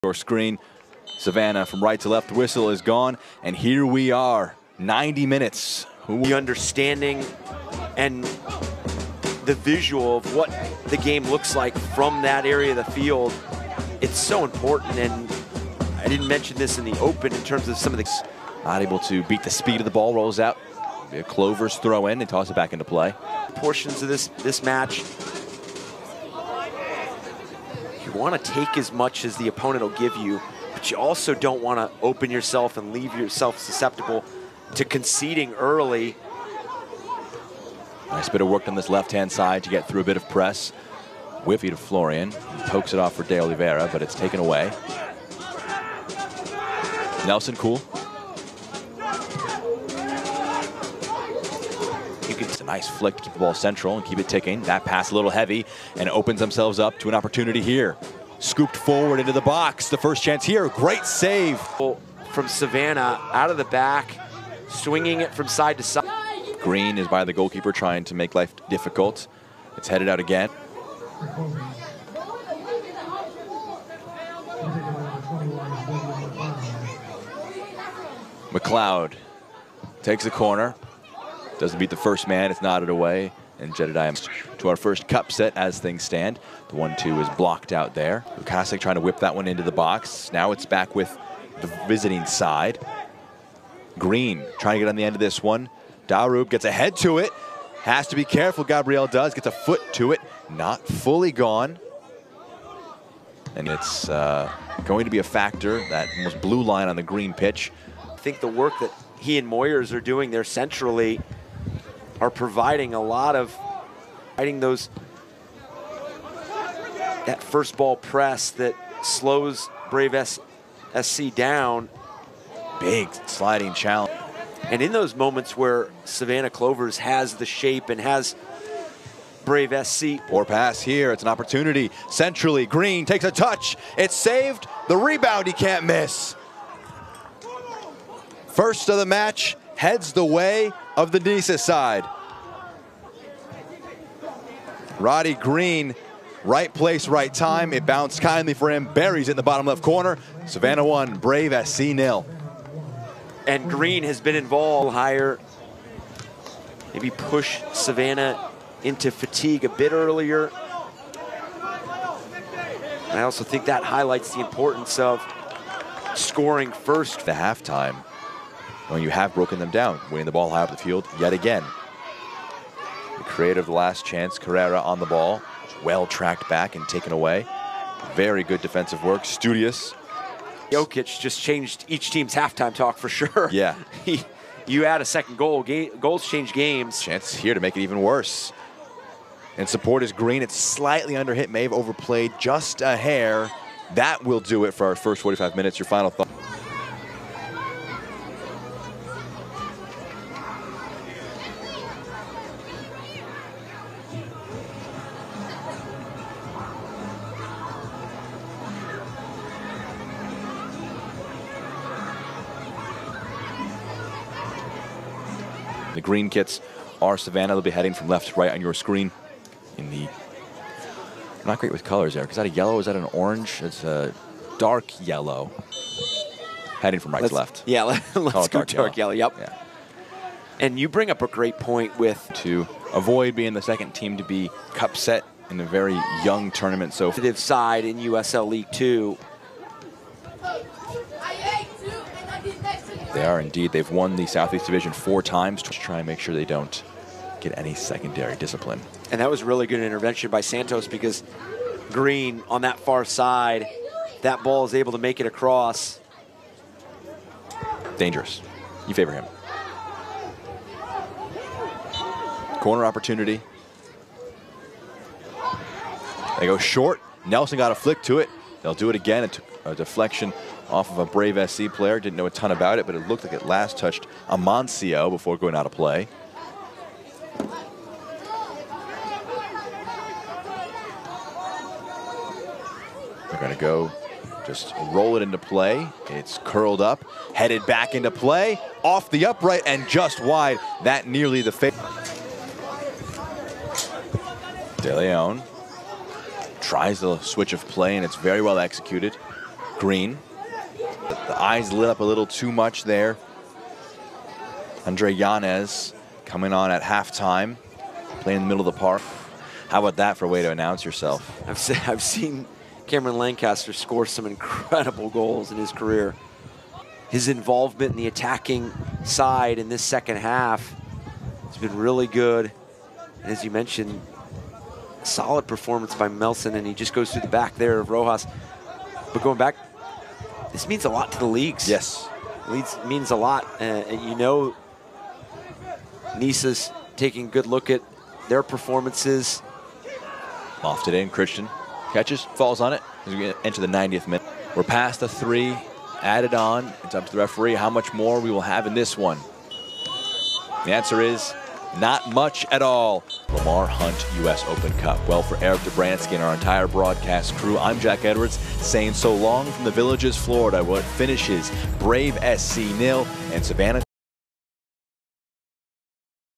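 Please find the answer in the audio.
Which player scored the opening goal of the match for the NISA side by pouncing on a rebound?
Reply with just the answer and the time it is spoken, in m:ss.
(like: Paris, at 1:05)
Roddy Green, at 2:25.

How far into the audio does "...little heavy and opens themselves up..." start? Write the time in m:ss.
0:55.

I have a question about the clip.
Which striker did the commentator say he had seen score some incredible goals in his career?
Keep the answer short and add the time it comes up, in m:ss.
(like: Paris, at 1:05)
Cameron Lancaster, at 5:12.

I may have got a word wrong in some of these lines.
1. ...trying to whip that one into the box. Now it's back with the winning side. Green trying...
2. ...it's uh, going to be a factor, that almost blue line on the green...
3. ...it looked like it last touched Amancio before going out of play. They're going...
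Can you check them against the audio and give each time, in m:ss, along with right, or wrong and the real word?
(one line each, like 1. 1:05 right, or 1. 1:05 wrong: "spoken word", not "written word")
1. 1:28 wrong: "visiting", not "winning"
2. 1:43 right
3. 4:32 right.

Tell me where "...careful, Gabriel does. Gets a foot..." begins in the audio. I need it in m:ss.
1:38.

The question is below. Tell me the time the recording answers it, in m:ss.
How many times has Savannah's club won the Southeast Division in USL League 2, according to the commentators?
4:04.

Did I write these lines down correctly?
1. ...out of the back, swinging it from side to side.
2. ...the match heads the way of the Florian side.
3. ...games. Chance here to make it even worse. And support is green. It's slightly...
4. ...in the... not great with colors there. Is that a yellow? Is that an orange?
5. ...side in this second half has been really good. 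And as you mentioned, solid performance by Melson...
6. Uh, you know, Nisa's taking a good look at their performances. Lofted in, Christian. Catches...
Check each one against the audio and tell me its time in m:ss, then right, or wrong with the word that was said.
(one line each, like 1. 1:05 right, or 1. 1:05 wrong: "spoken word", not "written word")
1. 1:03 right
2. 2:18 wrong: "Nisa", not "Florian"
3. 3:06 right
4. 3:39 right
5. 5:19 right
6. 5:33 right.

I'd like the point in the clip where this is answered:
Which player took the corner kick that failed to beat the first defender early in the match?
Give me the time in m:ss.
1:18.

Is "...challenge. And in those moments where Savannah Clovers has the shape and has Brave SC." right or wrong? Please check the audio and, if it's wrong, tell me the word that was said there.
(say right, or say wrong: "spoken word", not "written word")
right.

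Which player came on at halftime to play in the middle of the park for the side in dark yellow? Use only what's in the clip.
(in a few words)
Andre Yanez.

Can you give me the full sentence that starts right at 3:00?
Jokic just changed each team's halftime talk for sure.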